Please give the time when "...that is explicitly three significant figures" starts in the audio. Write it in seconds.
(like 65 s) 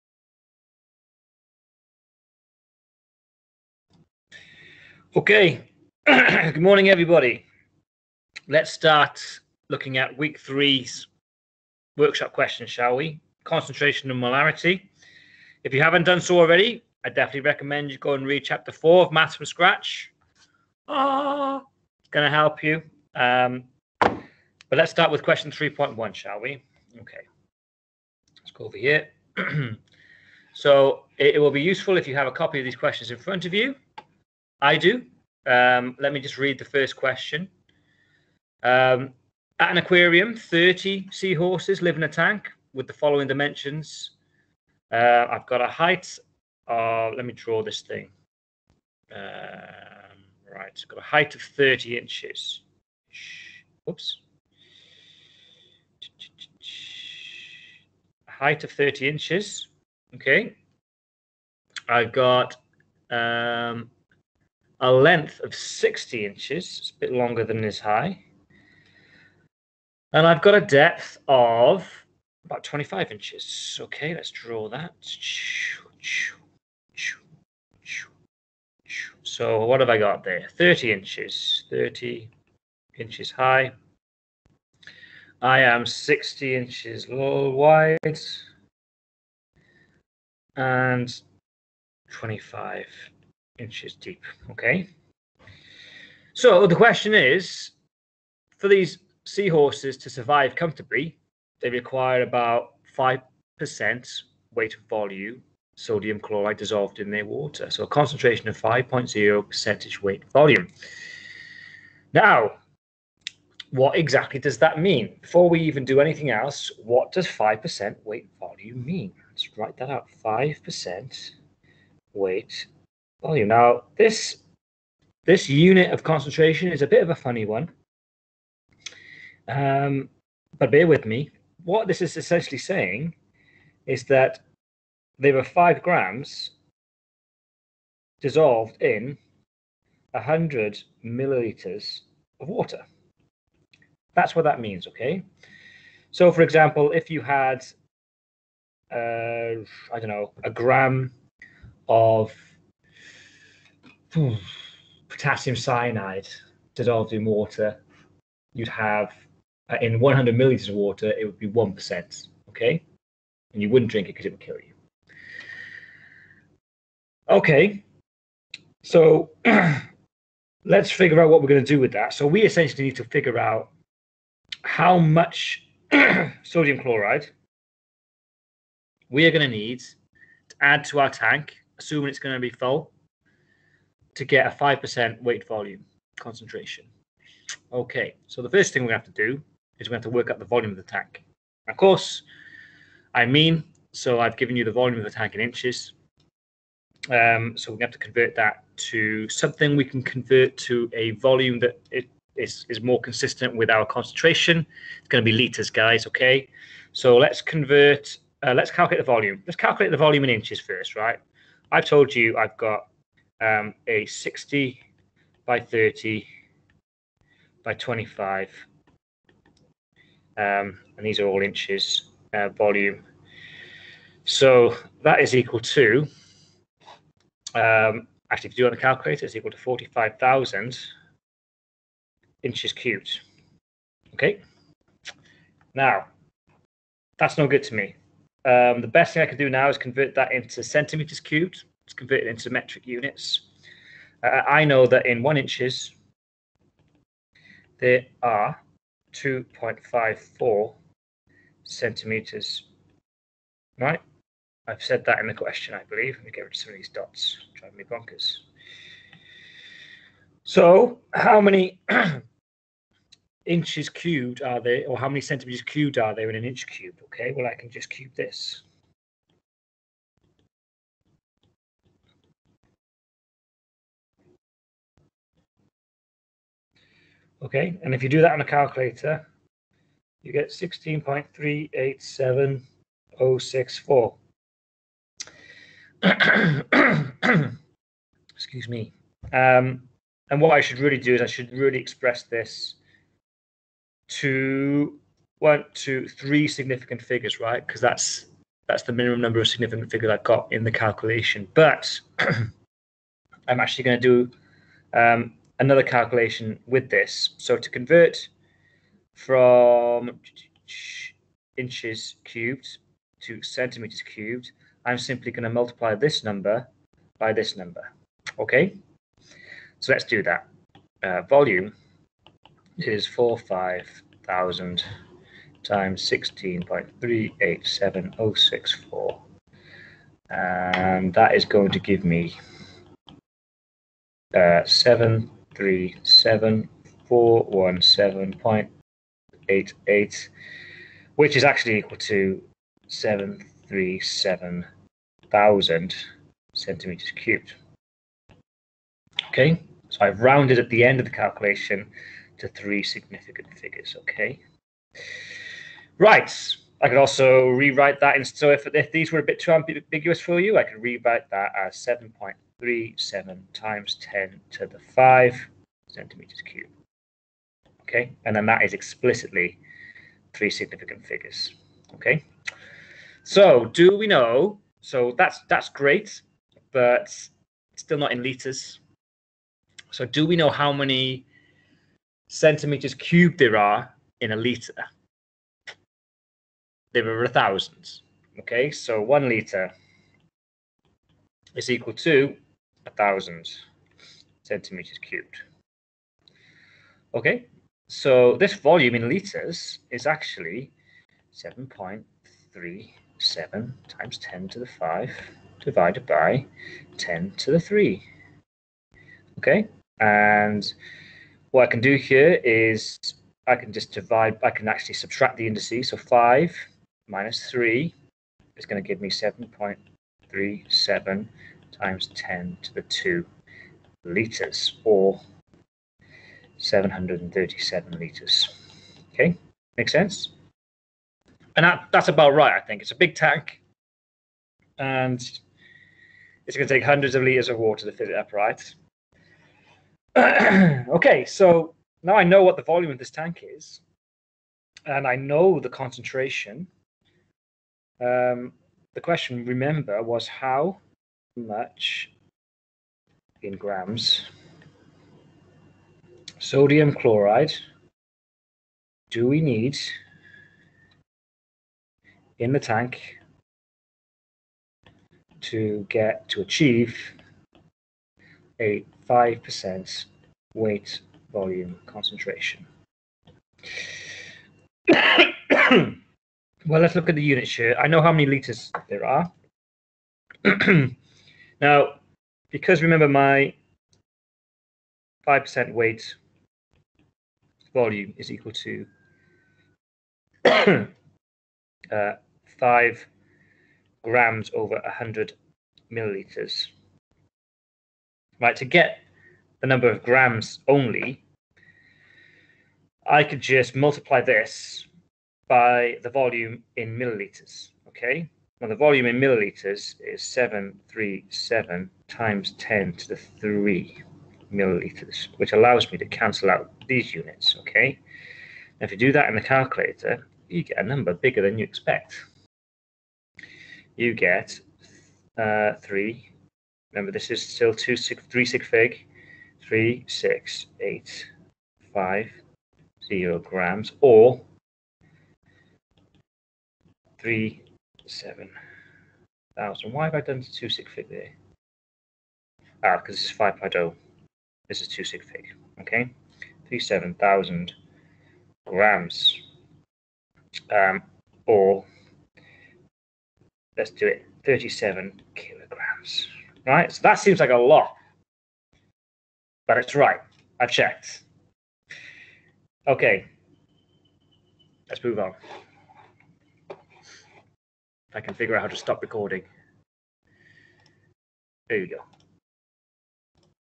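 368 s.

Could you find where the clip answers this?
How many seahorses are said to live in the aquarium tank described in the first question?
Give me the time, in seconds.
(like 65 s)
40 s.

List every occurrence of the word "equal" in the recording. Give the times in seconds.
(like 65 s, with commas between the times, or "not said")
225 s, 229 s, 341 s, 391 s, 488 s.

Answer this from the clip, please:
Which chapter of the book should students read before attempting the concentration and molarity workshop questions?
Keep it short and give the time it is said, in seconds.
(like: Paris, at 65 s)
Chapter four, at 18 s.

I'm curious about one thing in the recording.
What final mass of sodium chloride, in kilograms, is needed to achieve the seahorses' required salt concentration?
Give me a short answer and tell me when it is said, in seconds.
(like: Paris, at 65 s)
37 kg, at 554 s.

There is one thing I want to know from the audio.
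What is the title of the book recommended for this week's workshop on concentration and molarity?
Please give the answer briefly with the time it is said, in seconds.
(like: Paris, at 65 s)
Maths from Scratch, at 19 s.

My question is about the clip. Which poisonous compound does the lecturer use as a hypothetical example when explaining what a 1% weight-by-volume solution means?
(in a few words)
Potassium cyanide.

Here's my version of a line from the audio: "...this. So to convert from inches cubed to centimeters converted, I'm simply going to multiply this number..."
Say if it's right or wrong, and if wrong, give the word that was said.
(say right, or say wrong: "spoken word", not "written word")
wrong: "cubed", not "converted".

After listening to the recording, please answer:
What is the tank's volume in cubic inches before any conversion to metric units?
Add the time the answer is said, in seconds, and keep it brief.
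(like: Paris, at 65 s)
45,000 cubic inches, at 229 s.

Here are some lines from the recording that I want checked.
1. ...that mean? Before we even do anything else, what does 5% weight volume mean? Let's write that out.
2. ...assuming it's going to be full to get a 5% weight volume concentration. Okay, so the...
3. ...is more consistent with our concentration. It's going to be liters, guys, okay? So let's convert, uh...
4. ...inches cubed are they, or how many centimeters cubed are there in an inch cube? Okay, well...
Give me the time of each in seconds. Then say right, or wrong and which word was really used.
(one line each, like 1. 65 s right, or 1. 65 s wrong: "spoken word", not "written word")
1. 114 s right
2. 181 s right
3. 202 s right
4. 263 s right.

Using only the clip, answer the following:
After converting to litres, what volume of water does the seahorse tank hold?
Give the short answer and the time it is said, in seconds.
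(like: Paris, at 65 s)
737 litres, at 426 s.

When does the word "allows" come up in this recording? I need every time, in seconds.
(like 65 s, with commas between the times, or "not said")
515 s.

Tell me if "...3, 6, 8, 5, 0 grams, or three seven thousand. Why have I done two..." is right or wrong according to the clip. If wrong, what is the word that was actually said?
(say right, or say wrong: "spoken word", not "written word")
right.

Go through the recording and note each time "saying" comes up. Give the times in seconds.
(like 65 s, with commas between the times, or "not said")
132 s.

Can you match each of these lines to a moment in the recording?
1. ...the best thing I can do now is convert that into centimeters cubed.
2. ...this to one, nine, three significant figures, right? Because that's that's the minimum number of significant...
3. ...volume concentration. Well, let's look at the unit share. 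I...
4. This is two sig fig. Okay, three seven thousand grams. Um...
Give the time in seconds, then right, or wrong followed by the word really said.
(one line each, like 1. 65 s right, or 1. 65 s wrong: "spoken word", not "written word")
1. 238 s right
2. 292 s wrong: "two", not "nine"
3. 471 s right
4. 544 s right.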